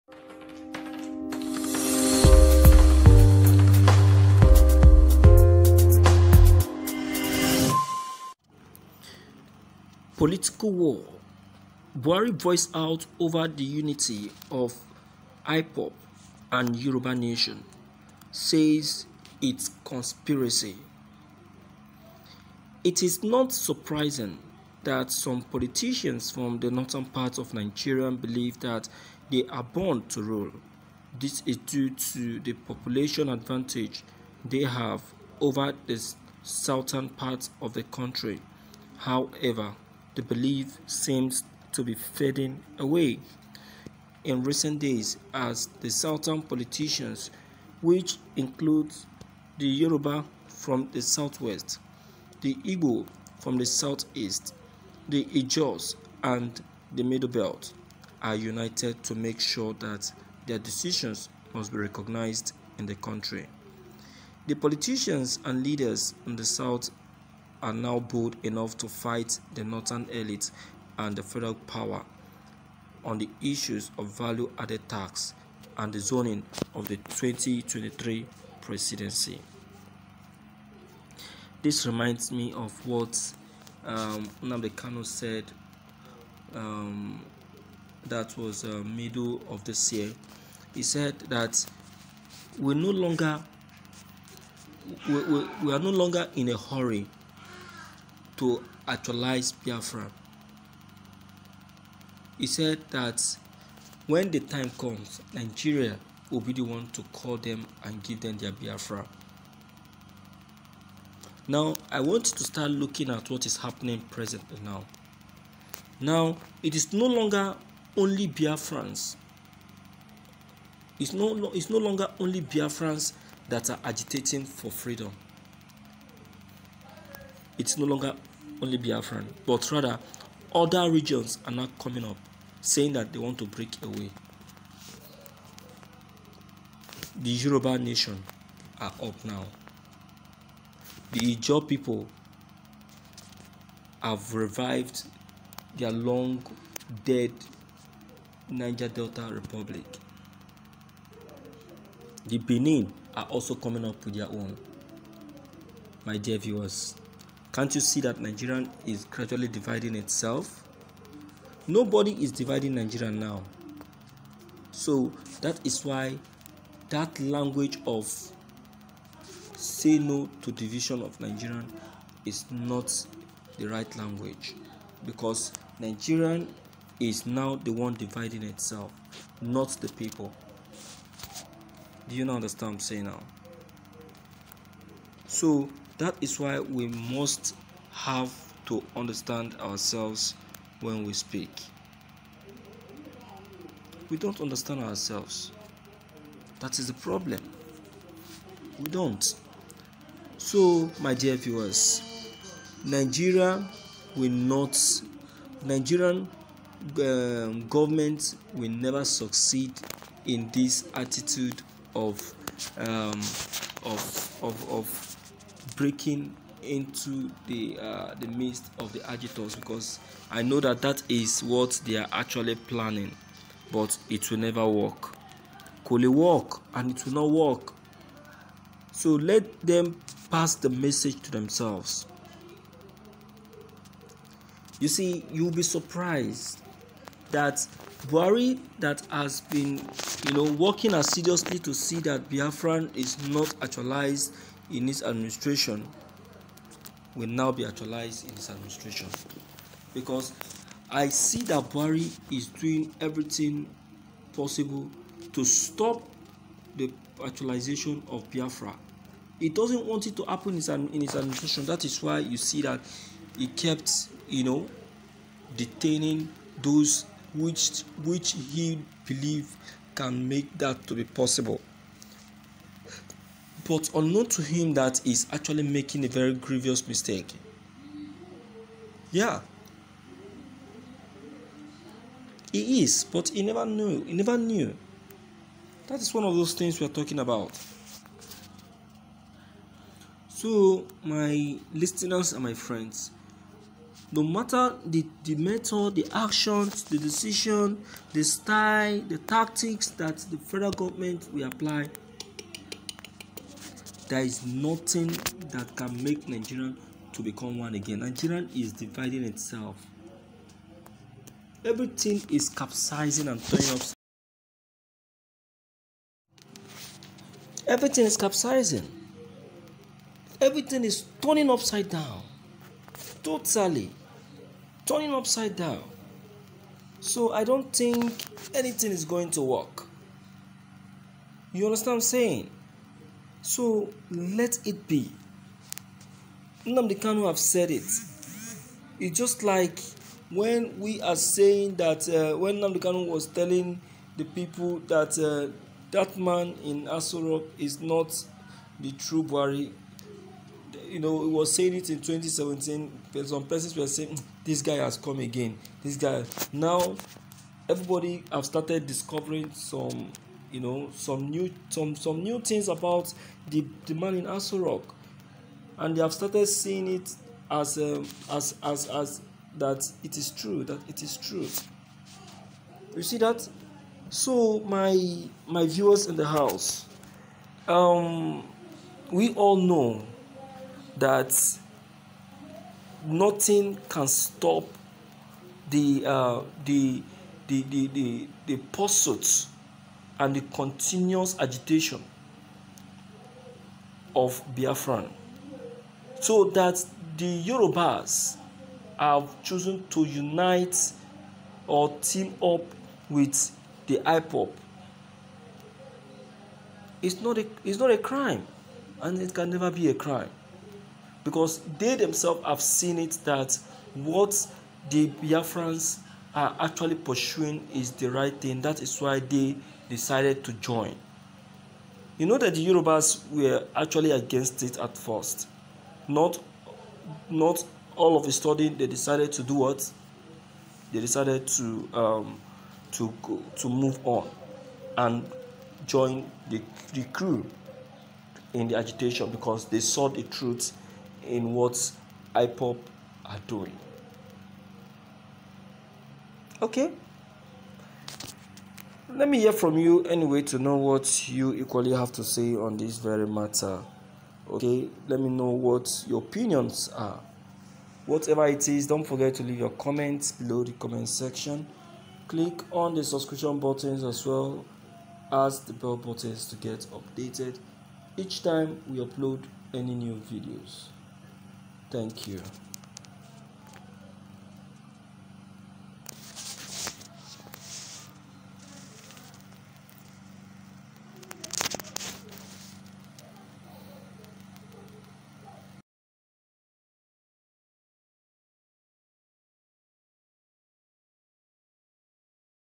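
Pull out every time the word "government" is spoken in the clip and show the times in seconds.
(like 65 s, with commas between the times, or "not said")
207 s, 300 s.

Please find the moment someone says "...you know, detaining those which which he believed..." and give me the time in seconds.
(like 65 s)
264 s.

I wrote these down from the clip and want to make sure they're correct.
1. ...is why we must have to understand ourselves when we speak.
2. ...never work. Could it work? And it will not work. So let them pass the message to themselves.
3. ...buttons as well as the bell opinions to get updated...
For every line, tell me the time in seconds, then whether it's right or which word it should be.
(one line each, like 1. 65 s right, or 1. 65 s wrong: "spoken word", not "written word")
1. 186 s right
2. 224 s right
3. 463 s wrong: "buttons", not "opinions".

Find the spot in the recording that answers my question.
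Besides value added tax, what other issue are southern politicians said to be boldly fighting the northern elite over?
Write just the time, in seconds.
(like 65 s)
75 s.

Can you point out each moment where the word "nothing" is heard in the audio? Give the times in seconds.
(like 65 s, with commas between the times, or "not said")
304 s, 383 s.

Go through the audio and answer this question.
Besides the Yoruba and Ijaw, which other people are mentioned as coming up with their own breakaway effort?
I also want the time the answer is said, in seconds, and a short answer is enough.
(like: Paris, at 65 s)
Benin, at 152 s.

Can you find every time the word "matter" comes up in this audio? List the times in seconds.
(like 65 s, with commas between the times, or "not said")
294 s, 453 s.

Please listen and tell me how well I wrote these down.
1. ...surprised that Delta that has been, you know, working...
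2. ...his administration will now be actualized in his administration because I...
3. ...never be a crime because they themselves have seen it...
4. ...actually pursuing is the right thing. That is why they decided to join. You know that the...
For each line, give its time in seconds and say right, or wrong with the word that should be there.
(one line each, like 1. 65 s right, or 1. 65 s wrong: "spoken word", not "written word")
1. 235 s wrong: "Buhari", not "Delta"
2. 244 s right
3. 409 s right
4. 416 s right.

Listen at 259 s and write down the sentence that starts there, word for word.
He doesn't want it to happen in his administration.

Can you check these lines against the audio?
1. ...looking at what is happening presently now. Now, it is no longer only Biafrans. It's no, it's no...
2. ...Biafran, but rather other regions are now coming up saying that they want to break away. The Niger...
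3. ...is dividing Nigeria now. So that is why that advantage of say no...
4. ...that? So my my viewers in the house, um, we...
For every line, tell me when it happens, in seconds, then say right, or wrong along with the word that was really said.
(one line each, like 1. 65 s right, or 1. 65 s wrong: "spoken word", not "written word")
1. 112 s right
2. 128 s wrong: "Yoruba", not "Niger"
3. 162 s wrong: "language", not "advantage"
4. 373 s right.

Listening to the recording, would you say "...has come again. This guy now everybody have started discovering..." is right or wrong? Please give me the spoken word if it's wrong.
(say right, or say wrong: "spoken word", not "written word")
right.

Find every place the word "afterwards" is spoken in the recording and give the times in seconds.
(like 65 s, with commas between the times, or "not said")
not said.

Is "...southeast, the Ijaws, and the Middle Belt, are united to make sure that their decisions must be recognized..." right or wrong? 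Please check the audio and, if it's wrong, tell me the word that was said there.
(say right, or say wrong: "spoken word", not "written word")
right.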